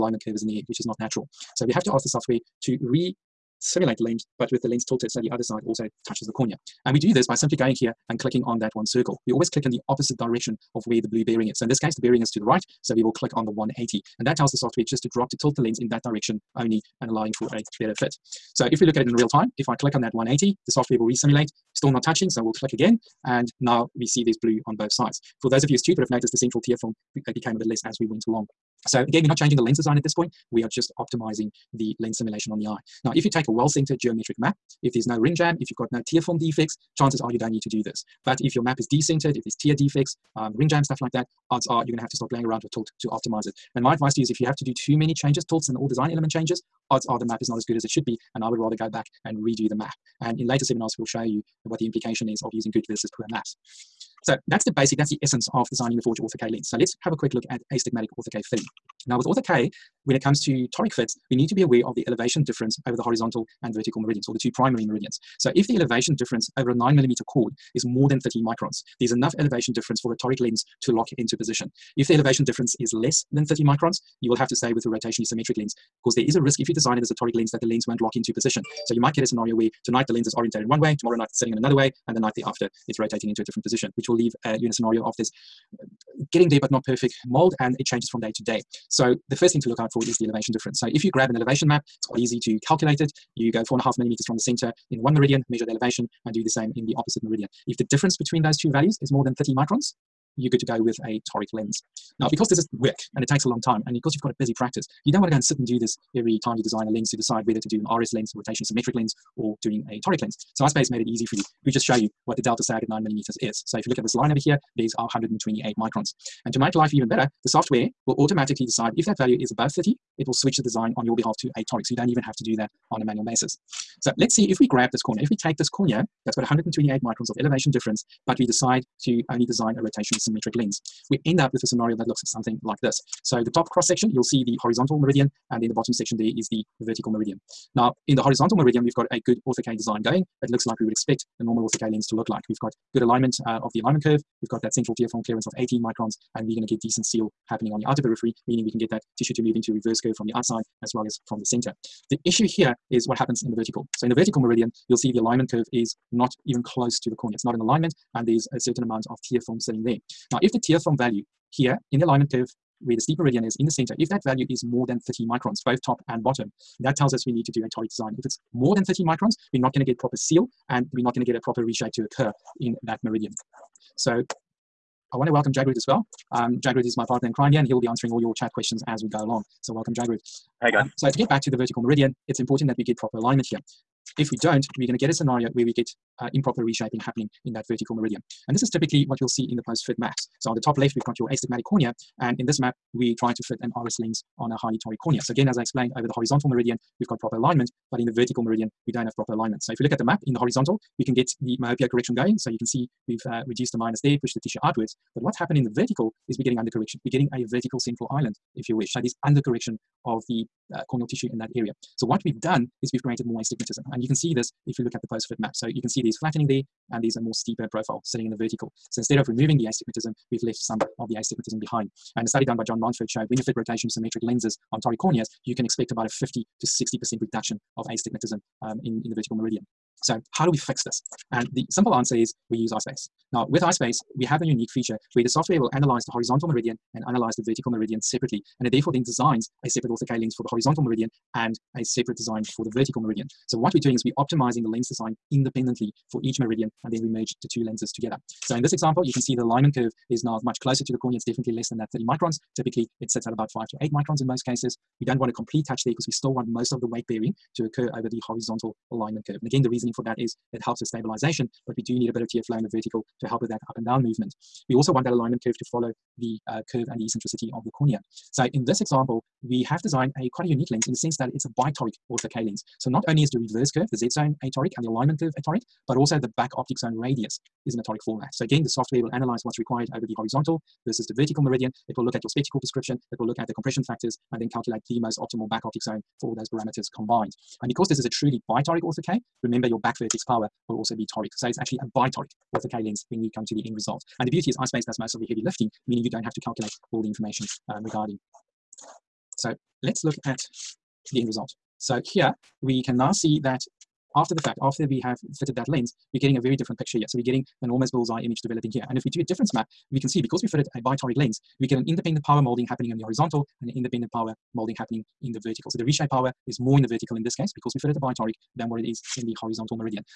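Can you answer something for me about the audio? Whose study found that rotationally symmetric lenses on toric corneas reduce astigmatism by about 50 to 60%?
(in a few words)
John Mountford.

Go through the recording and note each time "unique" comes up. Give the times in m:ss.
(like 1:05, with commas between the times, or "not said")
3:54, 4:30.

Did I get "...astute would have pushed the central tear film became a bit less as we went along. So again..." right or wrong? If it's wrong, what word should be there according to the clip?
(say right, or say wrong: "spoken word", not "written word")
wrong: "noticed", not "pushed".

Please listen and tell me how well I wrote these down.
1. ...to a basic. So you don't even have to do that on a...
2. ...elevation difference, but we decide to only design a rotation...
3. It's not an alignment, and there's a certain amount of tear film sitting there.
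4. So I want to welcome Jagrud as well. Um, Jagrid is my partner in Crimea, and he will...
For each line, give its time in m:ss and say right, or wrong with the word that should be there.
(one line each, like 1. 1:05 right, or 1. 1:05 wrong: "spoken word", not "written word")
1. 2:01 wrong: "toric", not "basic"
2. 2:07 right
3. 2:37 right
4. 2:53 right.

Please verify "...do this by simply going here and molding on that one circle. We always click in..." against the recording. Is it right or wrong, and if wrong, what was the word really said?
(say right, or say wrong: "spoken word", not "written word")
wrong: "clicking", not "molding".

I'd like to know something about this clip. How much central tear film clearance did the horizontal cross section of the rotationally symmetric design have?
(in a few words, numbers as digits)
18 microns.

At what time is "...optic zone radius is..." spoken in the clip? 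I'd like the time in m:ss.
4:36.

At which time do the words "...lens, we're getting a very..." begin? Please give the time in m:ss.
5:05.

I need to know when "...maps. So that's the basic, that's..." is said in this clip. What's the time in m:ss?
0:53.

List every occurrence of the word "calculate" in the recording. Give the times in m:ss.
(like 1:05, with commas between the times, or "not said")
1:32, 4:44, 4:56.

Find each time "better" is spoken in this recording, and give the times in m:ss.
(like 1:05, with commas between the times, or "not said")
0:17, 1:57.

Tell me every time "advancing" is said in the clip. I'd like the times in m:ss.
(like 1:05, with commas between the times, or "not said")
not said.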